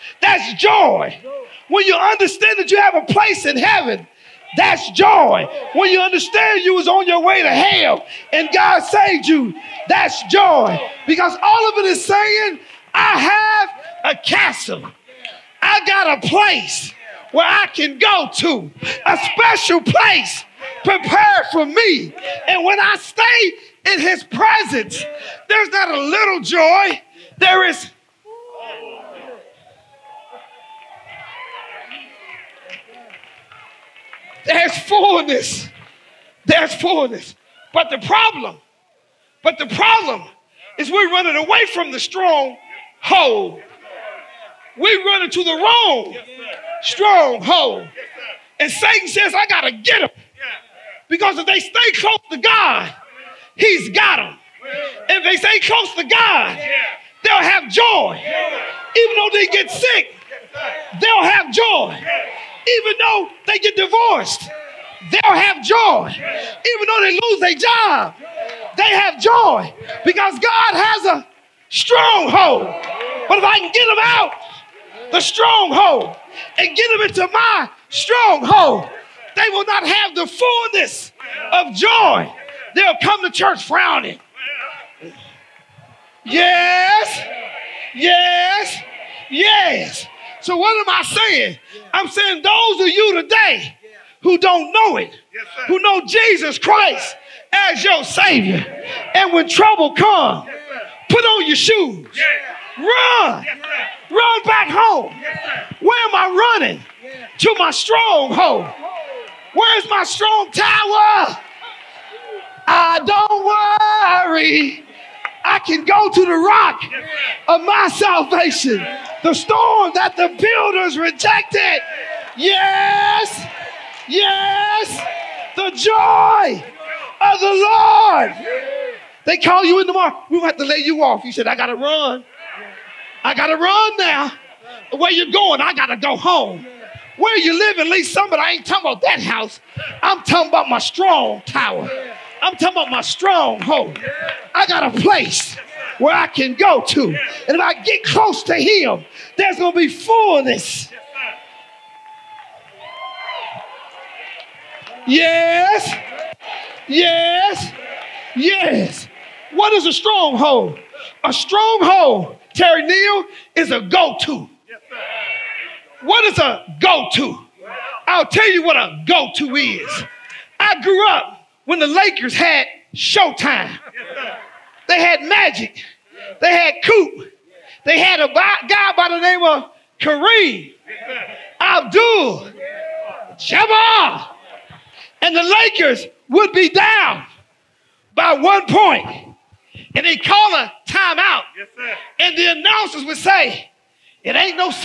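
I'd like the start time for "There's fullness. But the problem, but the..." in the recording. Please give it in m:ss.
0:36.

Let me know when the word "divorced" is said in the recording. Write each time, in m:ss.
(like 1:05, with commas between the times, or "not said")
1:03.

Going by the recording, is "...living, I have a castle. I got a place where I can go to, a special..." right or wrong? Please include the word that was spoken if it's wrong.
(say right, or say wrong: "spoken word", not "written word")
wrong: "saying", not "living".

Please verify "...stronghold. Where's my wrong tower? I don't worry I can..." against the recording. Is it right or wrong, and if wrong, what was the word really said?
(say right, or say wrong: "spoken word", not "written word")
wrong: "strong", not "wrong".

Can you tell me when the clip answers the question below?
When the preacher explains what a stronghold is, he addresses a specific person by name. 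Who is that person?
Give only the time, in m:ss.
2:42.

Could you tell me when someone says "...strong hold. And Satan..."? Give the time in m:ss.
0:46.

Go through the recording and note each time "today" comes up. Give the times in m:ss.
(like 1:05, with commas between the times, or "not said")
1:33.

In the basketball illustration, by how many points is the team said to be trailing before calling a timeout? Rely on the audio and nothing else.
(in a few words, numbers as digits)
1.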